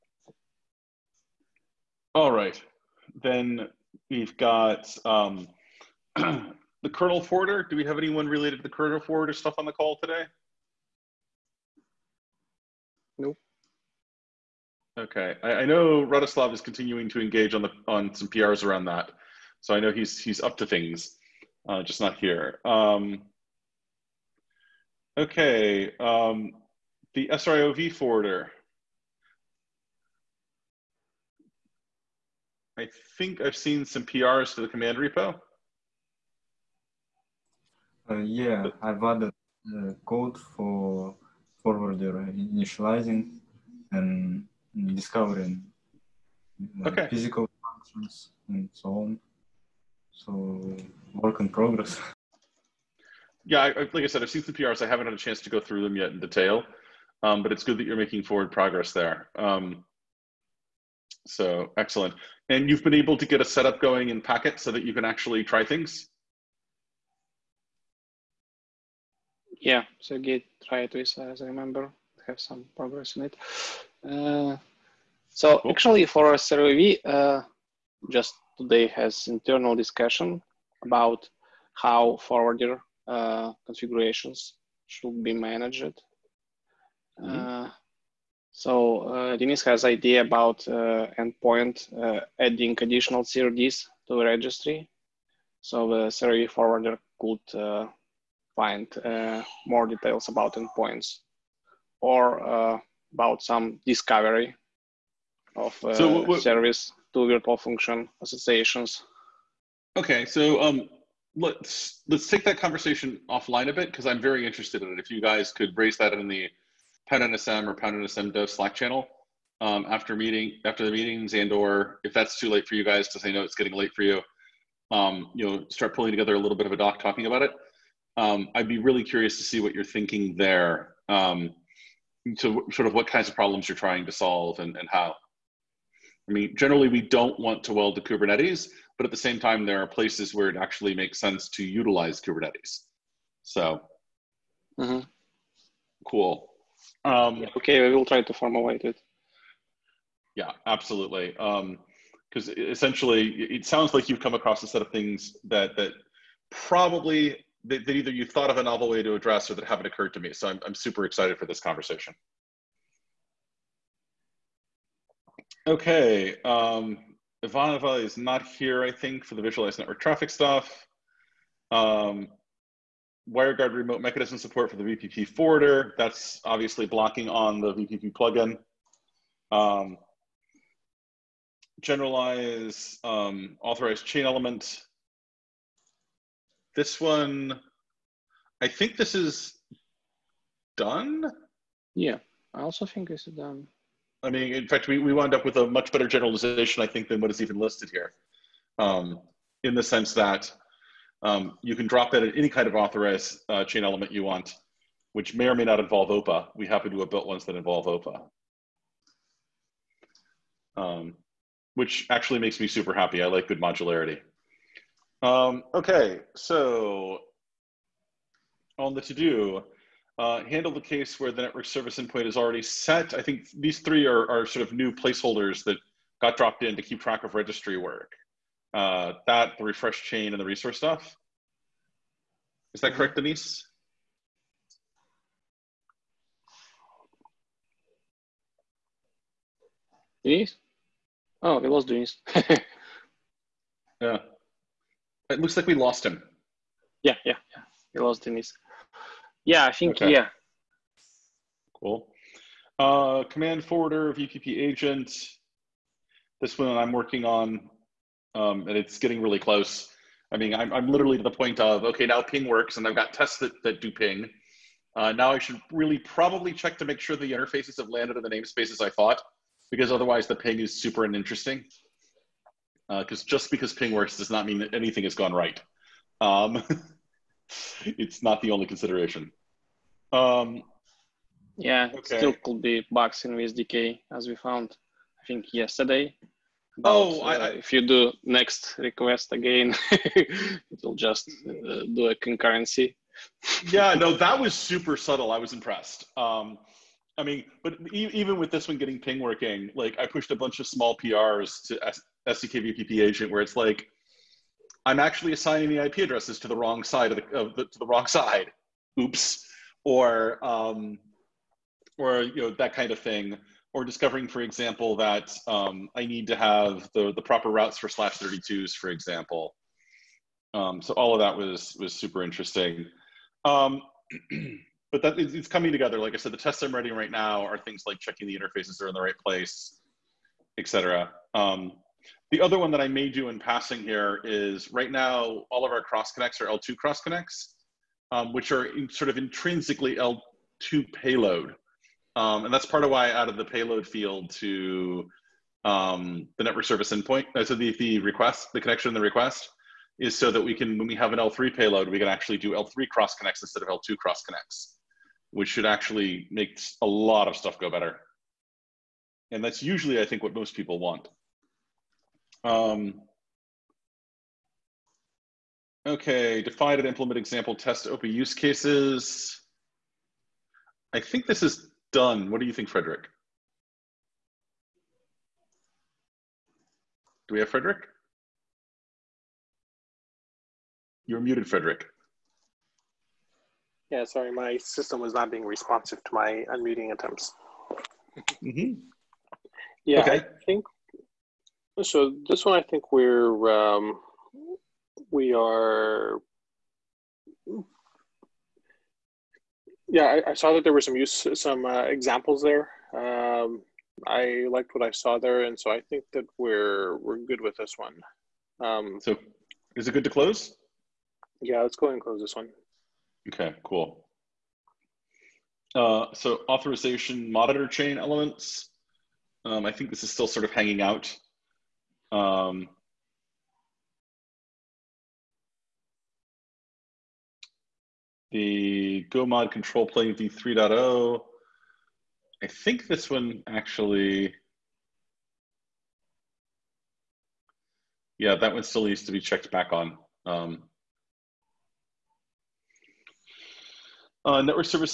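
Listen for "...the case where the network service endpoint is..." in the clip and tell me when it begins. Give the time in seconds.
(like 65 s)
220 s.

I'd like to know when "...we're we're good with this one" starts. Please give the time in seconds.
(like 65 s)
406 s.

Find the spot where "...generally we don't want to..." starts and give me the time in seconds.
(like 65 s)
136 s.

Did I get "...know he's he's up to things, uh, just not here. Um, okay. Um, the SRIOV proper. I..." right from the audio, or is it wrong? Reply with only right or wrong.
wrong.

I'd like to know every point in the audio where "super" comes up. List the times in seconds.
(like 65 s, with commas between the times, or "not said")
160 s, 212 s, 270 s, 294 s, 321 s.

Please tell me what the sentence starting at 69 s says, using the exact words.
Yeah, so Git try it with, as I remember, have some progress in it.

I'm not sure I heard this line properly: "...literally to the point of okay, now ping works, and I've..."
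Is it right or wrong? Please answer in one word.
right.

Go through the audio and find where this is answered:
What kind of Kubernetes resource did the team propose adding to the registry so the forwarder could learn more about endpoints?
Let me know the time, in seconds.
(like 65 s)
93 s.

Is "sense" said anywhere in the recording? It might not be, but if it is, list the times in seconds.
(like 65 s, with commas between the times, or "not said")
141 s, 199 s.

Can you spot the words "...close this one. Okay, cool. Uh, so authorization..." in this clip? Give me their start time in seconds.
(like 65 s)
412 s.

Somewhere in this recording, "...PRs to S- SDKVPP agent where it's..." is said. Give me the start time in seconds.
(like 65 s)
300 s.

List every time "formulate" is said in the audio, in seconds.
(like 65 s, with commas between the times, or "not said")
148 s.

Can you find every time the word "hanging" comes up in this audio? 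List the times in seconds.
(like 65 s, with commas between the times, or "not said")
420 s.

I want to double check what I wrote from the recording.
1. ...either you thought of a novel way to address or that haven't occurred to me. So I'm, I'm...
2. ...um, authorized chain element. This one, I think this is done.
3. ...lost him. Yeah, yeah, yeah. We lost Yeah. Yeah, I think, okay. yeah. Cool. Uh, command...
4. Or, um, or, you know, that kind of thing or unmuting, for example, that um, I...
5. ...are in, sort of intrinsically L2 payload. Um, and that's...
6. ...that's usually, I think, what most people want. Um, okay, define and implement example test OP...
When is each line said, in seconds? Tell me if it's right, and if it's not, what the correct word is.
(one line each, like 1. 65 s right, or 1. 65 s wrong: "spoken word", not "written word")
1. 157 s right
2. 183 s right
3. 245 s wrong: "Denise", not "Yeah"
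4. 309 s wrong: "discovering", not "unmuting"
5. 338 s right
6. 359 s right.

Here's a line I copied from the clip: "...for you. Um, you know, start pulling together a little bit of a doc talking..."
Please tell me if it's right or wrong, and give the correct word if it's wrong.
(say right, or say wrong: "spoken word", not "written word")
right.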